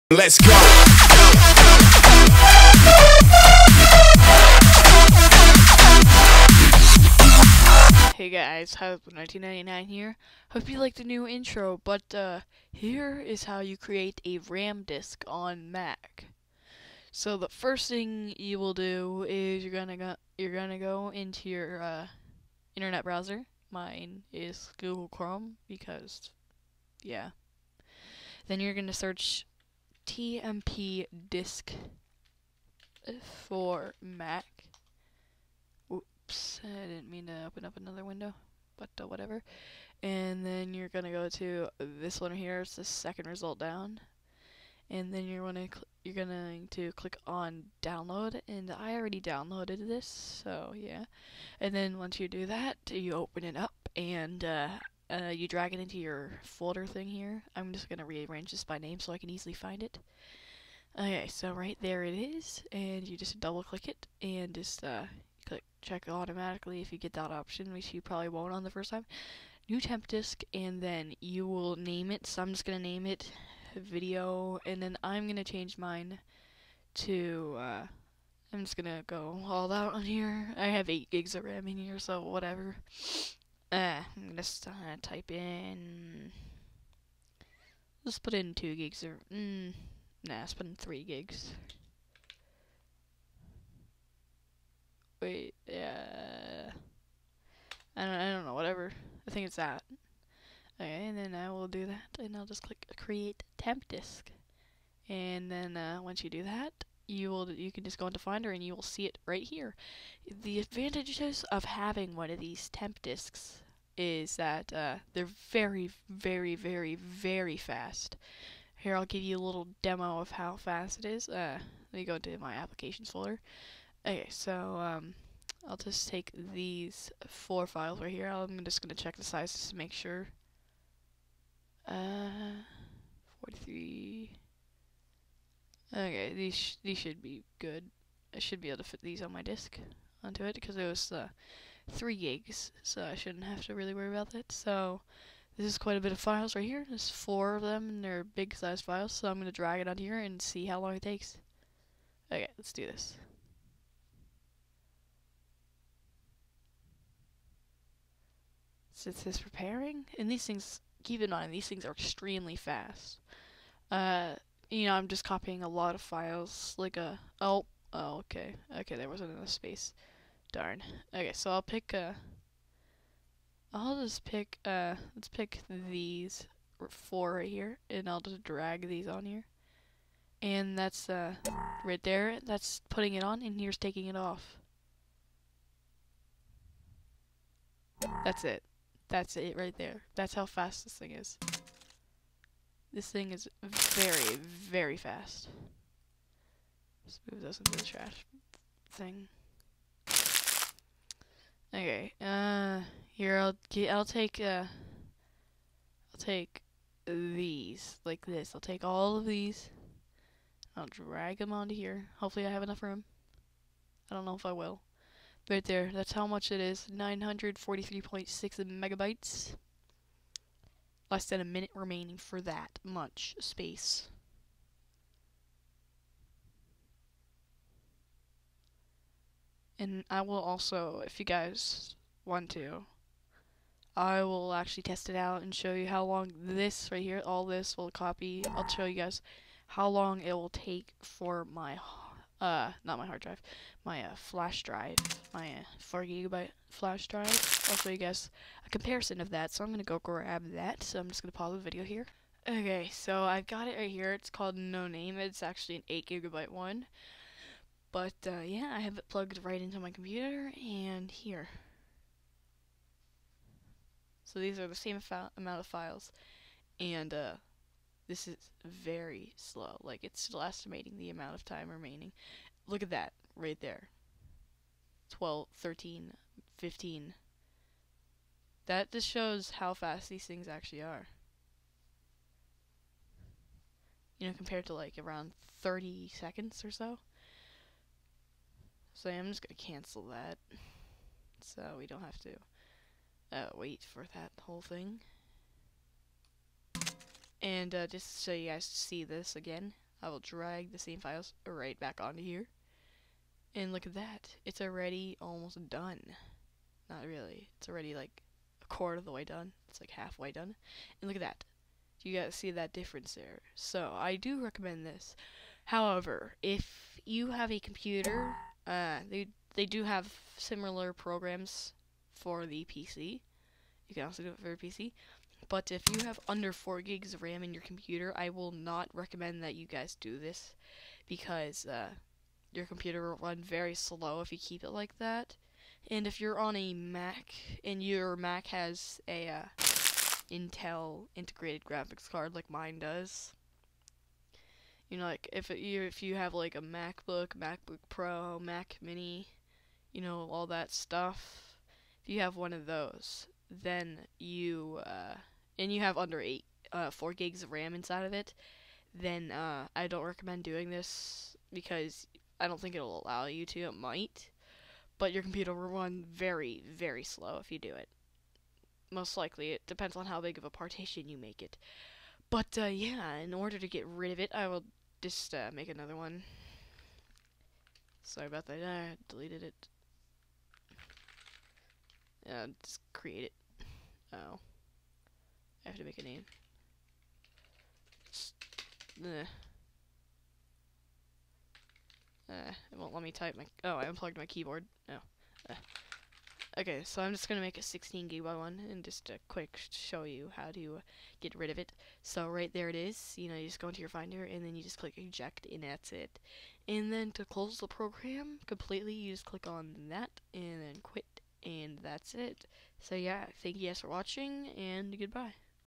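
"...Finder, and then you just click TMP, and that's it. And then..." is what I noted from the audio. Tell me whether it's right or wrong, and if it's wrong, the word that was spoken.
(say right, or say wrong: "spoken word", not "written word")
wrong: "Eject", not "TMP".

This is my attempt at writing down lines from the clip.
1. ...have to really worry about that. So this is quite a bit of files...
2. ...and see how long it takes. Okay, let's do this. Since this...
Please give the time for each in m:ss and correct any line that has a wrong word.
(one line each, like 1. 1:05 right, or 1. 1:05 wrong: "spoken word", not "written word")
1. 2:23 right
2. 2:30 right.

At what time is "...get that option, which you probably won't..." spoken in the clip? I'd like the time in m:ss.
1:06.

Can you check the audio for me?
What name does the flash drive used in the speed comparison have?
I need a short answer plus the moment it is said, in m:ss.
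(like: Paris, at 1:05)
No Name, at 4:14.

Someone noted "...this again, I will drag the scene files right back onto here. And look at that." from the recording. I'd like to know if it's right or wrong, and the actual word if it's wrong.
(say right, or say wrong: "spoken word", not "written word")
right.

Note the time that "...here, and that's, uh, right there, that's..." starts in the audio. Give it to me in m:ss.
2:59.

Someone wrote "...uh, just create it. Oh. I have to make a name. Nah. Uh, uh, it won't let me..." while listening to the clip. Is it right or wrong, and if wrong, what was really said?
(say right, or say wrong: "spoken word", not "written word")
right.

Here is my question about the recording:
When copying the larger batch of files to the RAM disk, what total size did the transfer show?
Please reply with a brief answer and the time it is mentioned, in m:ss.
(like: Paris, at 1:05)
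943.6 megabytes, at 3:36.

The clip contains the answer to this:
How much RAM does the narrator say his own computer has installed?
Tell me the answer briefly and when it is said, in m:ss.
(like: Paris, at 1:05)
8 gigs, at 1:20.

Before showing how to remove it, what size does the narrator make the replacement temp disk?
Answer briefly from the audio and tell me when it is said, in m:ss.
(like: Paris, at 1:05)
16 gigabytes, at 6:37.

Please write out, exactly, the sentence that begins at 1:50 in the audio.
The advantages of having one of these temp disks is that uh, they're very, very, very, very fast.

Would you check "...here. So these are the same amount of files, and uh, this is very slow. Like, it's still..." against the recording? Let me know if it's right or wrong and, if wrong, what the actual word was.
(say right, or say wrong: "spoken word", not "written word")
right.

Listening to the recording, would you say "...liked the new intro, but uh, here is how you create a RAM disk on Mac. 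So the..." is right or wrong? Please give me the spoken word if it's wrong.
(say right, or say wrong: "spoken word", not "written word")
right.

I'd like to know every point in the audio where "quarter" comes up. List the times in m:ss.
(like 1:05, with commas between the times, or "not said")
5:08.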